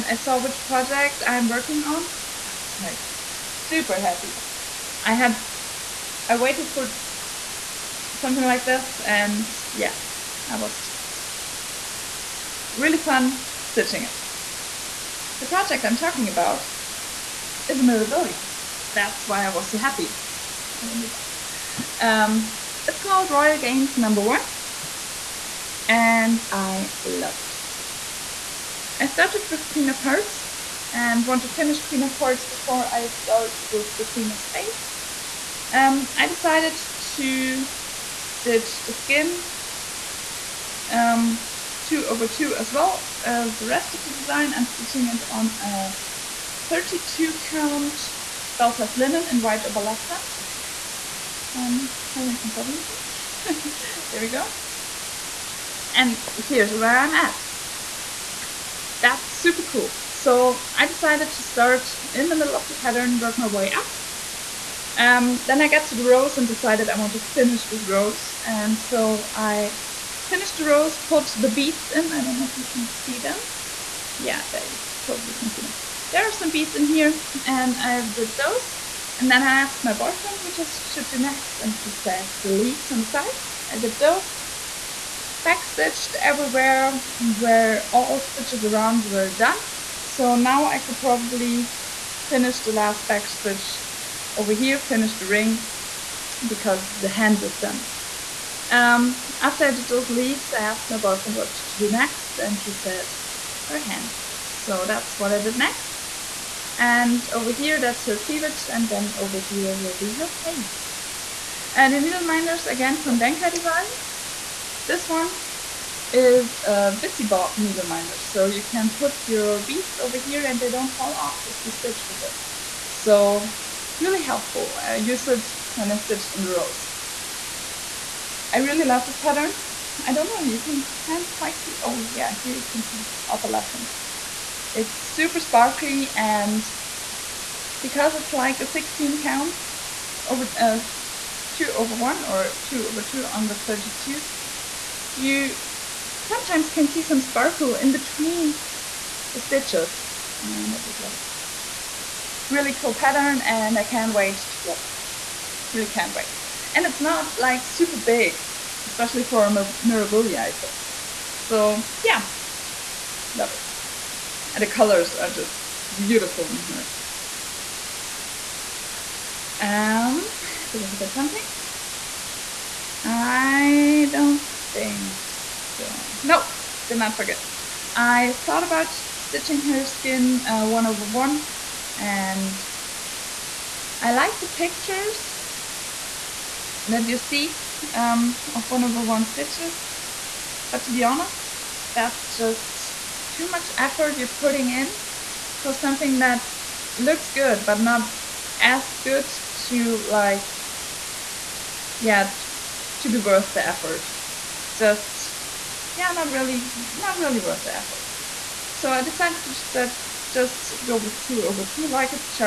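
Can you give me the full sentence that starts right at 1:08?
And so I Finish the rows, put the beads in.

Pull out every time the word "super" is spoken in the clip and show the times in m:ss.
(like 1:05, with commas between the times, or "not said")
0:03, 0:59, 2:15, 2:37.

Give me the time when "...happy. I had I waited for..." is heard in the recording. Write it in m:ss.
0:04.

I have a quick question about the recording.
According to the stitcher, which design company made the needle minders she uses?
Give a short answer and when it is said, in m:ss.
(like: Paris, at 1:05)
Denkai Designs, at 1:53.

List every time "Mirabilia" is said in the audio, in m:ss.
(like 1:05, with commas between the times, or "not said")
0:17, 2:39.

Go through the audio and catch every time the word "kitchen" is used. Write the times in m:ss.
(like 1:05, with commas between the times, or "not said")
not said.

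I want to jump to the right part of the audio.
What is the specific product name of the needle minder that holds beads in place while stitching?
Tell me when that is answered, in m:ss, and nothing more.
1:57.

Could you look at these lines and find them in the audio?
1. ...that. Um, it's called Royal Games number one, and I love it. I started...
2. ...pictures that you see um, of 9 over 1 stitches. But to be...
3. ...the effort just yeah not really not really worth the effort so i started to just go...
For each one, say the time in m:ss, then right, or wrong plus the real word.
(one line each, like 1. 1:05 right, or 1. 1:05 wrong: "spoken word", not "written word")
1. 0:21 right
2. 3:04 wrong: "1", not "9"
3. 3:23 wrong: "decided", not "started".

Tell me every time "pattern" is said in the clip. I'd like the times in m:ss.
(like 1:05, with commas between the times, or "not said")
1:02, 2:09, 2:32.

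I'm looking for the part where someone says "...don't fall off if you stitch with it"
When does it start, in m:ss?
2:00.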